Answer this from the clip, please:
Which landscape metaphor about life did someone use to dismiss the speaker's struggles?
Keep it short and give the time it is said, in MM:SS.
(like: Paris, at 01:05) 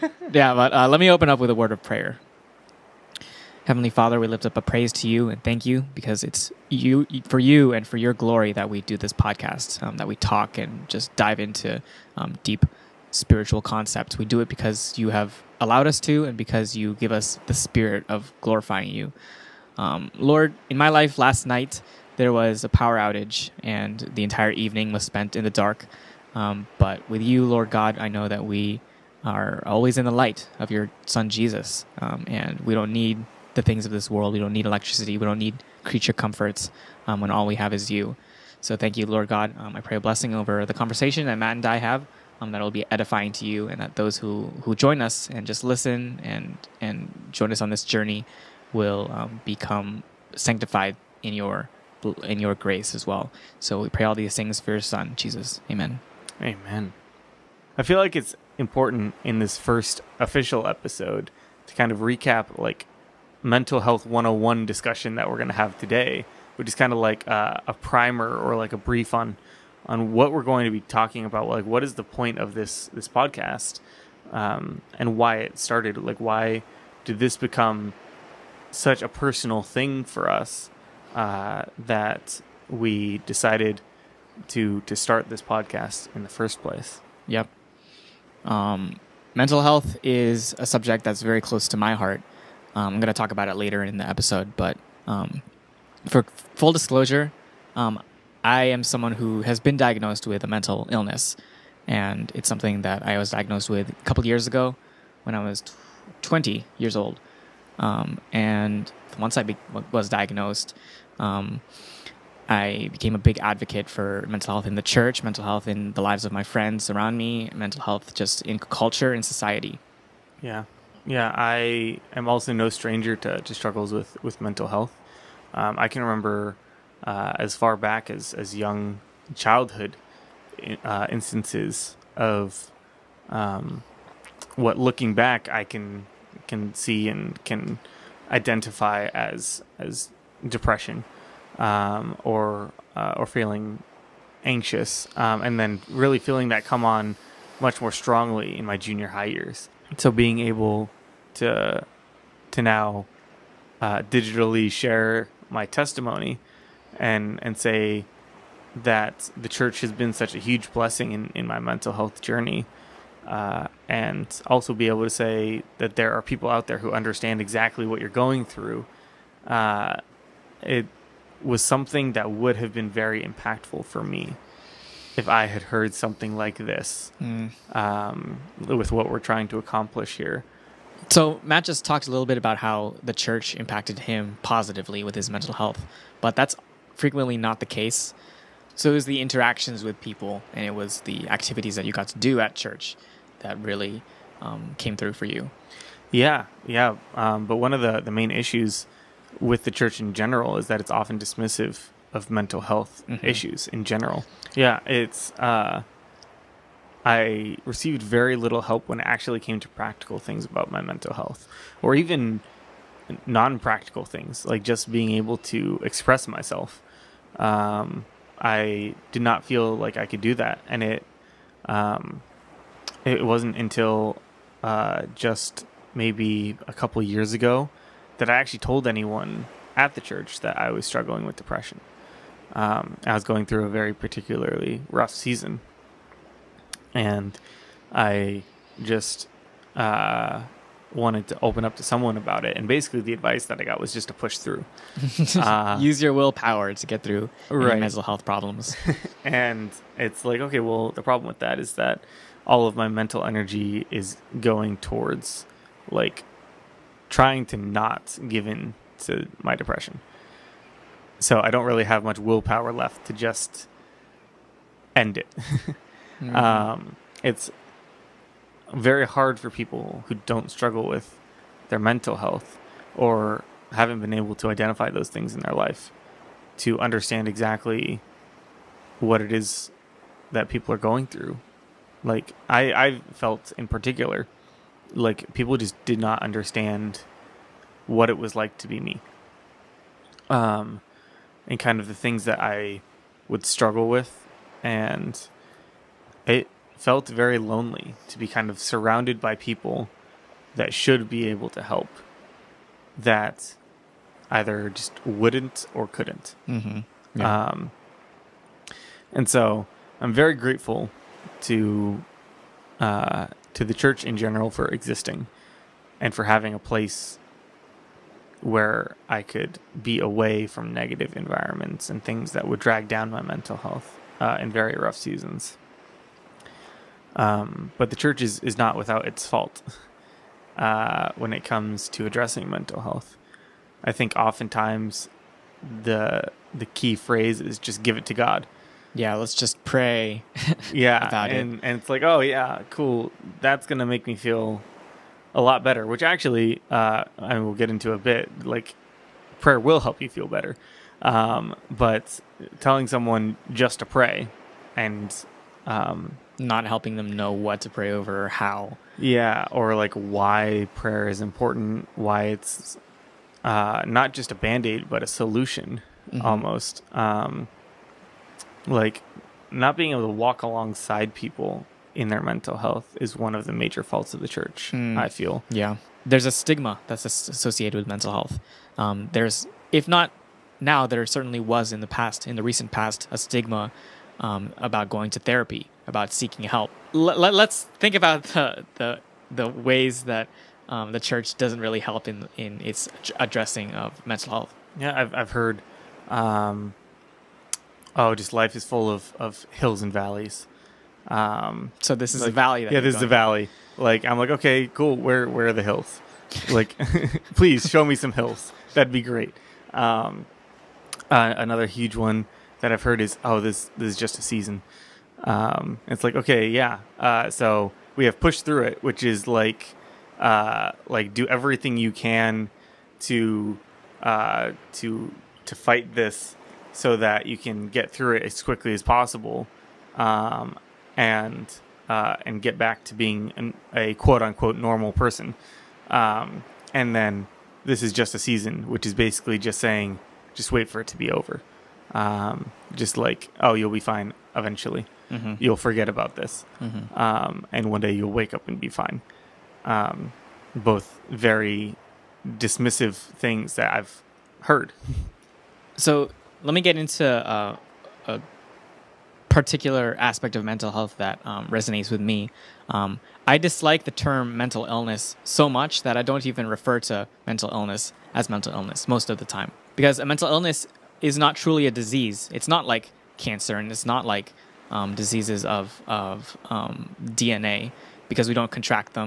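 hills and valleys, at 06:39.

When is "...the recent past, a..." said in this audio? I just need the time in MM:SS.
06:22.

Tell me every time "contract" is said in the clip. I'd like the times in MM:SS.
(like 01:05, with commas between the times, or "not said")
07:58.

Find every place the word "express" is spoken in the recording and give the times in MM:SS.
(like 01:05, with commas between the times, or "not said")
03:35.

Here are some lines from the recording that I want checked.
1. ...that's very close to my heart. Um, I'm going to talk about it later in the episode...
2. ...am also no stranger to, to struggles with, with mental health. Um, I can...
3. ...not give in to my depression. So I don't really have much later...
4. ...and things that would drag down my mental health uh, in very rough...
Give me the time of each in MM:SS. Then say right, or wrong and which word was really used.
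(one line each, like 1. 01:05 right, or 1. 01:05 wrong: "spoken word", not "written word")
1. 01:31 right
2. 02:02 right
3. 04:17 wrong: "willpower", not "later"
4. 05:21 right.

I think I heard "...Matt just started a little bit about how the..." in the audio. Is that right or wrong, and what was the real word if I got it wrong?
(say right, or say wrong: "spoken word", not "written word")
wrong: "talked", not "started".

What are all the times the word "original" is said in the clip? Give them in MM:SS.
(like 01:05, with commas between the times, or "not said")
not said.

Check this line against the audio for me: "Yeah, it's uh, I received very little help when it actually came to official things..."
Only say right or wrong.
wrong.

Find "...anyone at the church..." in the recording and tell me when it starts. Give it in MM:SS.
03:48.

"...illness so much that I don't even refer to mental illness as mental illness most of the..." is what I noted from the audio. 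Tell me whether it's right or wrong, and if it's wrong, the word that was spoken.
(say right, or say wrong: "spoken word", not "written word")
right.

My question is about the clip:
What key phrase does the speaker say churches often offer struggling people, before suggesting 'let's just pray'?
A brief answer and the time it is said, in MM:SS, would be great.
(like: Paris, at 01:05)
give it to God, at 05:37.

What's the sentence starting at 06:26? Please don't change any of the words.
Let, us think about the, the, the ways that um, the church doesn't really help in, in its addressing of mental health.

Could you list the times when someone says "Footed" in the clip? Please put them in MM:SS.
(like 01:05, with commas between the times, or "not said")
not said.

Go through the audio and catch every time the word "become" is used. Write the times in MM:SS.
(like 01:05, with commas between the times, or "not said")
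00:49, 01:17.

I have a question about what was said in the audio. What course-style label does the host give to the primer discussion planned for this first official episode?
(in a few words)
mental health 101.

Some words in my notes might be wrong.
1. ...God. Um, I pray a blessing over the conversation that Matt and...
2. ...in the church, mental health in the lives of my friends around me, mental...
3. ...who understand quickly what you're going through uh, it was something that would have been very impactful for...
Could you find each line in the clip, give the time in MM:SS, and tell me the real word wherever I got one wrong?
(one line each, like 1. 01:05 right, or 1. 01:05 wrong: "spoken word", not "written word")
1. 00:39 right
2. 01:54 right
3. 02:46 wrong: "exactly", not "quickly".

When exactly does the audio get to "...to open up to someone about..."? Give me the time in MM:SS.
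04:01.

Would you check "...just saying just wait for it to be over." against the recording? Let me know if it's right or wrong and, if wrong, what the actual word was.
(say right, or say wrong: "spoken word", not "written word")
right.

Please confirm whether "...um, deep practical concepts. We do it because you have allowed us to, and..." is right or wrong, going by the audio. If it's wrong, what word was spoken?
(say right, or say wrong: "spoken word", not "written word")
wrong: "spiritual", not "practical".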